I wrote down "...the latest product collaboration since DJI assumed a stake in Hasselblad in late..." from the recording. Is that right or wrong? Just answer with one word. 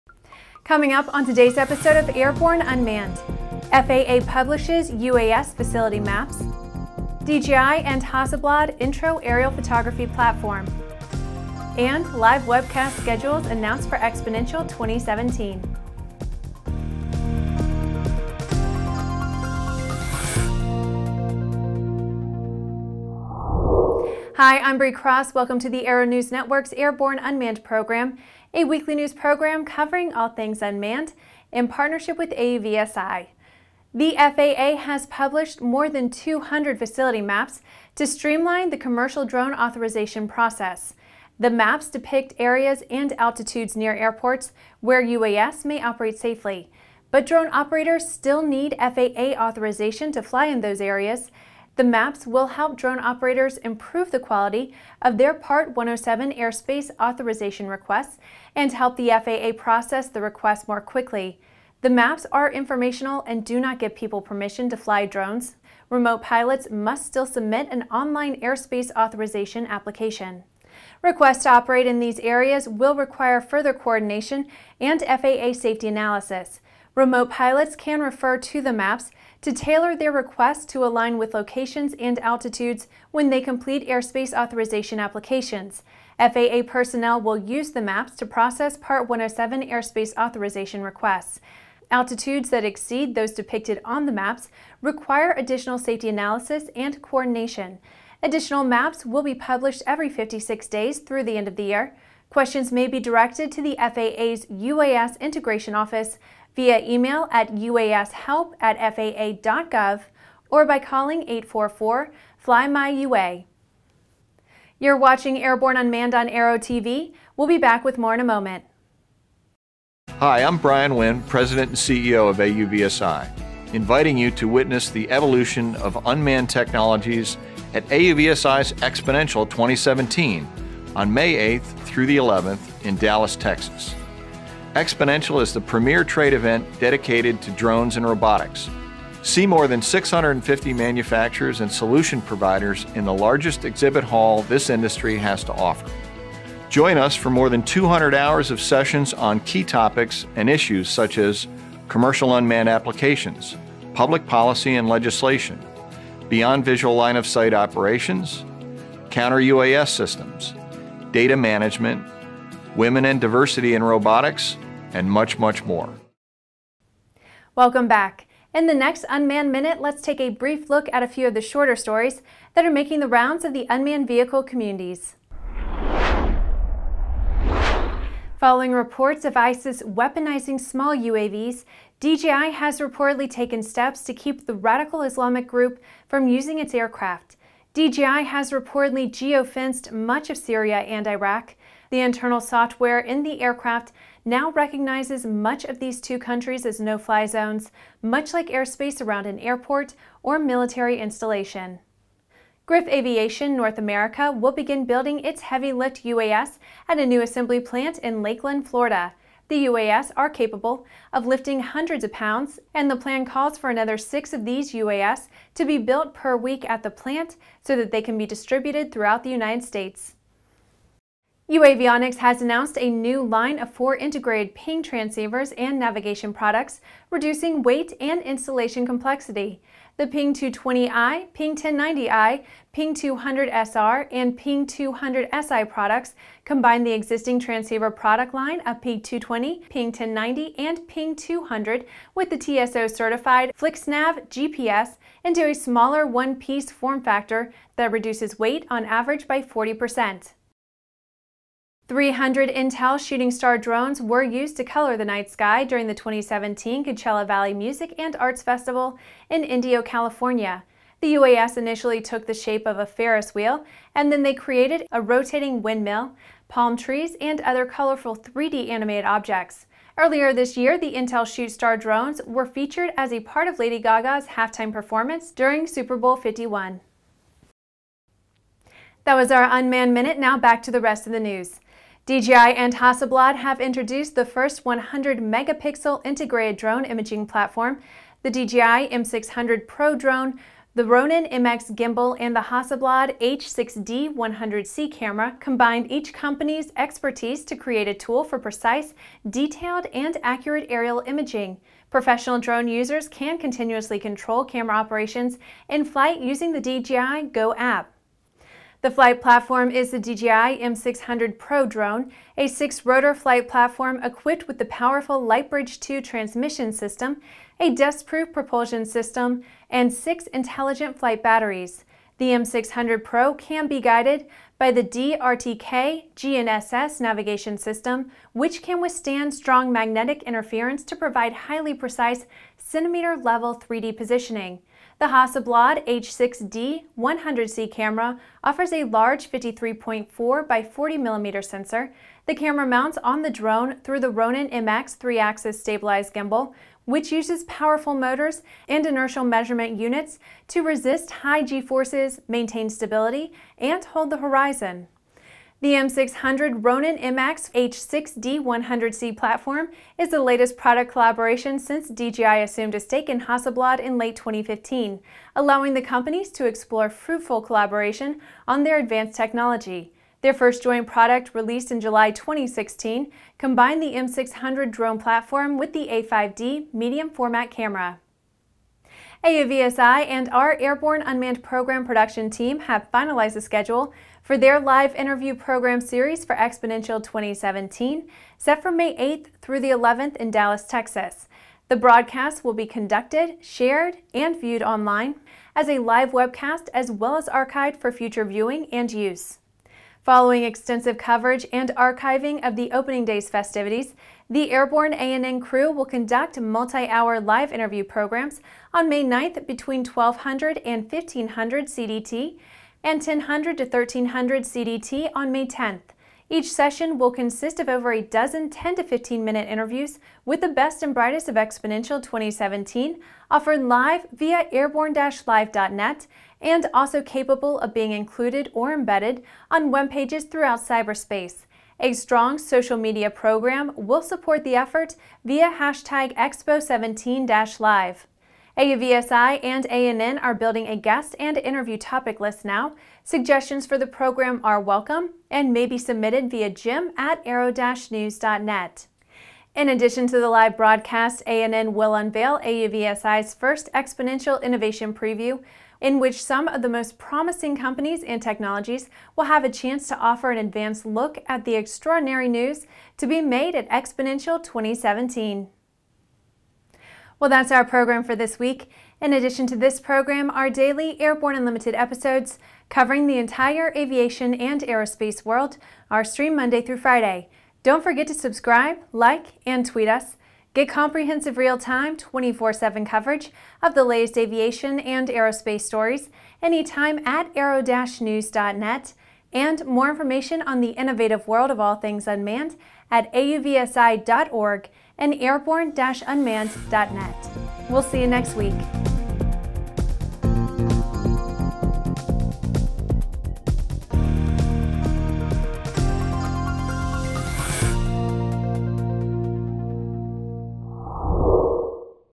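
right.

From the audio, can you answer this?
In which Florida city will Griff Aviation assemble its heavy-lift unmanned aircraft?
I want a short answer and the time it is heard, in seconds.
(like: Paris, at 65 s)
Lakeland, at 208 s.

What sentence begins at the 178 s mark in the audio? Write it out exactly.
Following reports of ISIS weaponizing small UAVs, DJI has reportedly taken steps to keep the radical Islamic group from using its aircraft.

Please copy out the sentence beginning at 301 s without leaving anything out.
Professional drone users can continuously control camera operations in flight using the DJI Go app.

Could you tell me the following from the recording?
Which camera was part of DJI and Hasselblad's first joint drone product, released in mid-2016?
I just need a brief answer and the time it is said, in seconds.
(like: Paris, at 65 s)
A5D, at 375 s.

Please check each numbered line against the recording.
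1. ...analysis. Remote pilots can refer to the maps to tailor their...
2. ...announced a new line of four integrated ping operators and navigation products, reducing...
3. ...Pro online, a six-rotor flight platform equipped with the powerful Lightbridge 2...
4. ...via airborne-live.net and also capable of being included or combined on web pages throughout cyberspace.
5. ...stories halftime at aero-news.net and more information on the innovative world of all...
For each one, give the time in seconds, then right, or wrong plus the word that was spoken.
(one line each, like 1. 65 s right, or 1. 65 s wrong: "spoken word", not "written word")
1. 75 s right
2. 222 s wrong: "transceivers", not "operators"
3. 311 s wrong: "drone", not "online"
4. 424 s wrong: "embedded", not "combined"
5. 485 s wrong: "anytime", not "halftime".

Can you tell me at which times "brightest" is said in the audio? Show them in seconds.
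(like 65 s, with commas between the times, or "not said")
420 s.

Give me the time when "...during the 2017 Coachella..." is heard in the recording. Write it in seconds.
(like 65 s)
255 s.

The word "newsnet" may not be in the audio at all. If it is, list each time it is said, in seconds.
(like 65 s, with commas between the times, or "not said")
447 s, 487 s.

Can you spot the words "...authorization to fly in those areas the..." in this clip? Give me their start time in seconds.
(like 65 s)
49 s.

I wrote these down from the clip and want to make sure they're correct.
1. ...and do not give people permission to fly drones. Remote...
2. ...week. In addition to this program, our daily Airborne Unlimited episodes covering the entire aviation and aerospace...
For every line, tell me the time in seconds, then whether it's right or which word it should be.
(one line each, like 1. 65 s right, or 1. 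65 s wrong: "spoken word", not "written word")
1. 63 s right
2. 468 s right.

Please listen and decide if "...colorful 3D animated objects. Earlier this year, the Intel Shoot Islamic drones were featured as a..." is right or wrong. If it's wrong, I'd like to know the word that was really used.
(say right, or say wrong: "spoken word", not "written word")
wrong: "Star", not "Islamic".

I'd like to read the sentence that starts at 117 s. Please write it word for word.
We'll be back with more in a moment.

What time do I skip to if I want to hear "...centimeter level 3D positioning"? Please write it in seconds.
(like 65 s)
332 s.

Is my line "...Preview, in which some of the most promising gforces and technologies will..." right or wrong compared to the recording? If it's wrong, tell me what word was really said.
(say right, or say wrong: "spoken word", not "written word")
wrong: "companies", not "gforces".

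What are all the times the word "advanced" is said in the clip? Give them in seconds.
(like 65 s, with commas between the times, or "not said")
368 s, 460 s.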